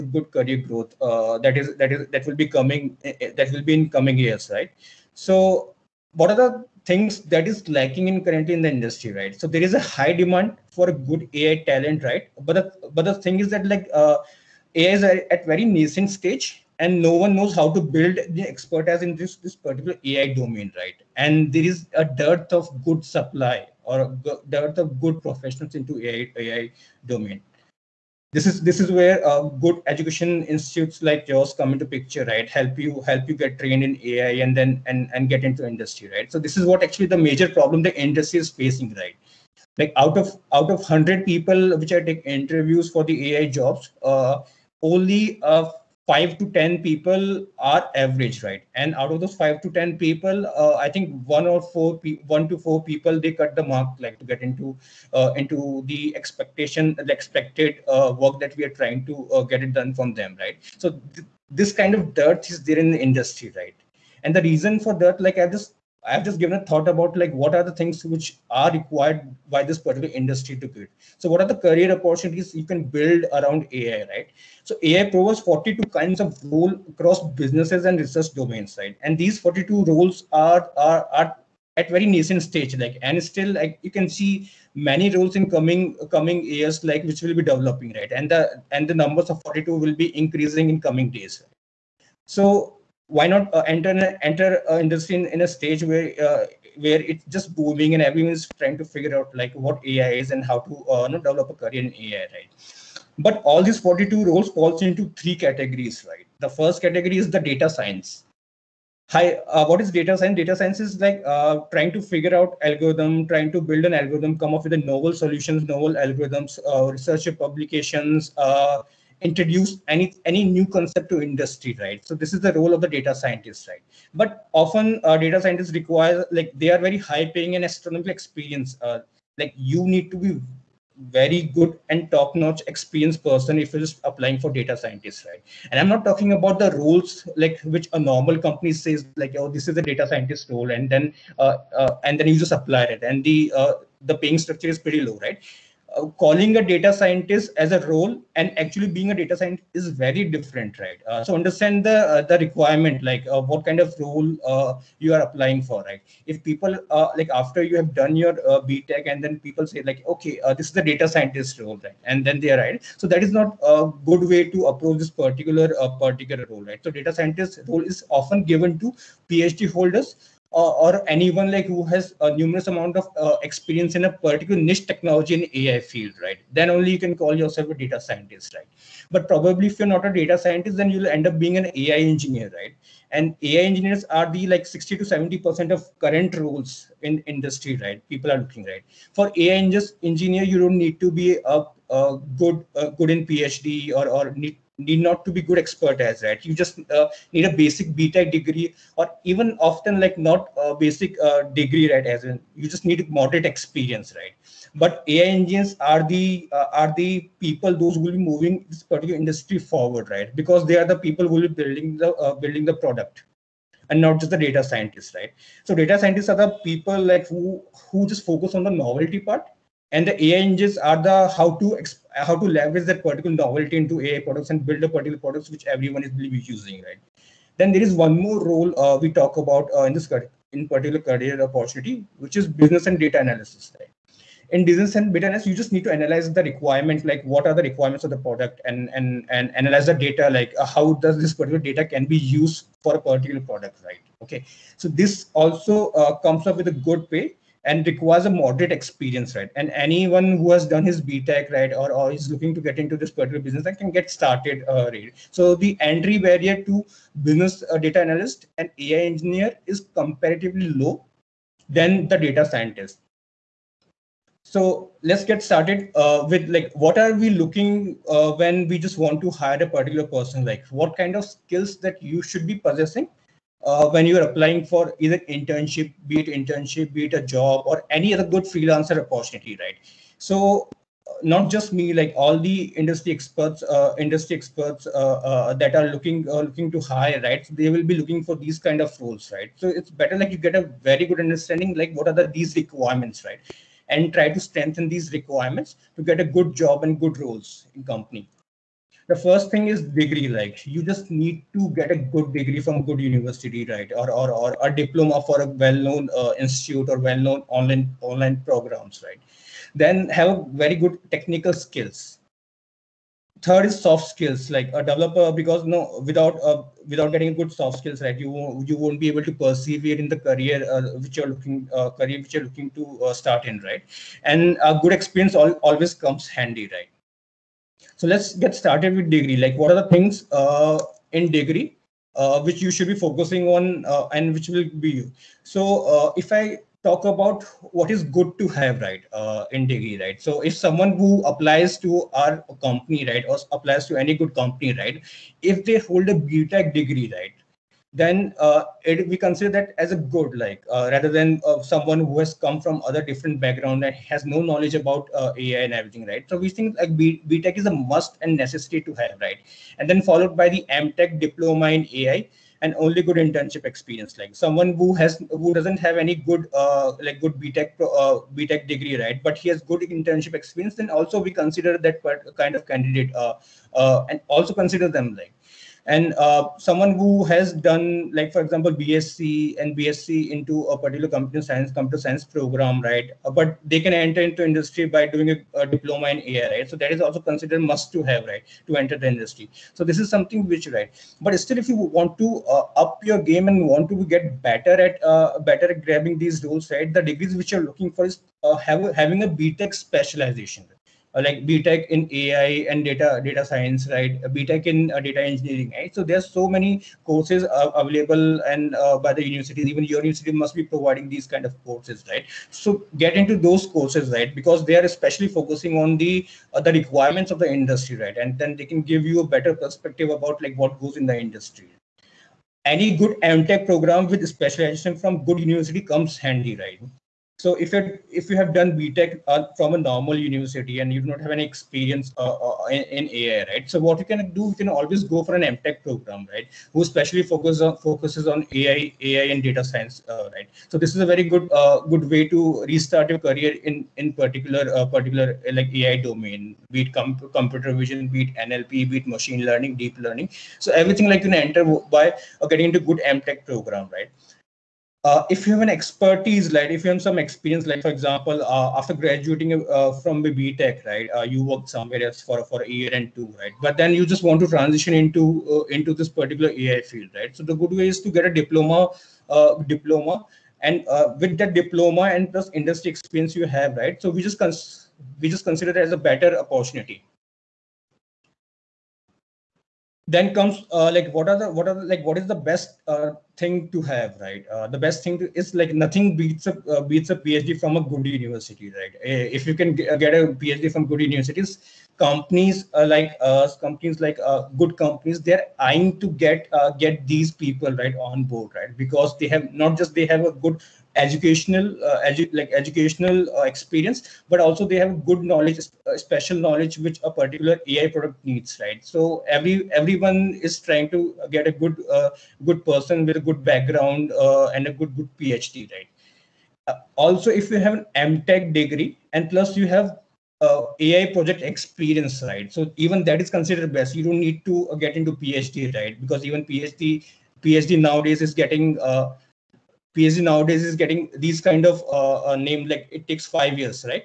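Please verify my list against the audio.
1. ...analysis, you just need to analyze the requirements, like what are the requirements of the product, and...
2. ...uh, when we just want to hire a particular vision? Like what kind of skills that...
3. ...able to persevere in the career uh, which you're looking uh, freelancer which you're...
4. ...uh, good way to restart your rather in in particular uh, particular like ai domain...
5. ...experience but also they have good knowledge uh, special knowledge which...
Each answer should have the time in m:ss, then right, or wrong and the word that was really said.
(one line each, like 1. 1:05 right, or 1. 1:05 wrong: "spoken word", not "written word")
1. 3:55 right
2. 4:28 wrong: "person", not "vision"
3. 5:19 wrong: "career", not "freelancer"
4. 7:21 wrong: "career", not "rather"
5. 8:23 right.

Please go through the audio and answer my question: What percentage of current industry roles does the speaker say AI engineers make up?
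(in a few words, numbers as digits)
60 to 70%.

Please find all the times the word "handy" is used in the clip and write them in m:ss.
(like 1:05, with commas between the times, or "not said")
5:26, 7:06.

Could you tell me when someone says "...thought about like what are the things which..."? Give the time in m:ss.
1:06.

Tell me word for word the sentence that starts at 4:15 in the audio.
So the entry barrier to business uh, data analyst and AI engineer is comparatively low than the data scientist.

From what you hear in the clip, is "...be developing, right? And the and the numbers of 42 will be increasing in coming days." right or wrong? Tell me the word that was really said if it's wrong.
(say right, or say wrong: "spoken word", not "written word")
right.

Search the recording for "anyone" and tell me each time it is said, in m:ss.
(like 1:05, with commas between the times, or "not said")
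2:51, 4:09.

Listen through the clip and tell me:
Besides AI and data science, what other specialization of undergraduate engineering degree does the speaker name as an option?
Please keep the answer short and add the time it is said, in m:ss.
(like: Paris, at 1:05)
Data engineering, at 6:44.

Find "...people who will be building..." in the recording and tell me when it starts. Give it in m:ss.
3:31.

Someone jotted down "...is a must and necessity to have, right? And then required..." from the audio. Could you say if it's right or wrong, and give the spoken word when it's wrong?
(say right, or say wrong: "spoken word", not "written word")
wrong: "followed", not "required".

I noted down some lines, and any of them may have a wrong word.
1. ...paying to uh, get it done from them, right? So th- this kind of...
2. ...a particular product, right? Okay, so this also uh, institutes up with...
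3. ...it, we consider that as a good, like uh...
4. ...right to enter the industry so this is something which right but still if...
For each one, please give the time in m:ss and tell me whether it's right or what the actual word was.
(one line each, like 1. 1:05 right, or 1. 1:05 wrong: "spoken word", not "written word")
1. 0:58 wrong: "trying", not "paying"
2. 4:02 wrong: "comes", not "institutes"
3. 5:48 right
4. 6:28 right.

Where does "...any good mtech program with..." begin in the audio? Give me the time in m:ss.
7:02.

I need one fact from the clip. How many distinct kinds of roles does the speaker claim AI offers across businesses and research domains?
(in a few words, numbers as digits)
42.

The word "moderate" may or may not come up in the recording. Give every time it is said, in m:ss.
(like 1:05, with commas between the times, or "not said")
3:23, 4:08.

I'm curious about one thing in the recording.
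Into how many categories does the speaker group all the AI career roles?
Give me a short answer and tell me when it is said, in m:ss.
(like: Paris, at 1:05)
3, at 1:45.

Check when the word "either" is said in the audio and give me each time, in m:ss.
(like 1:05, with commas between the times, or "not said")
4:34.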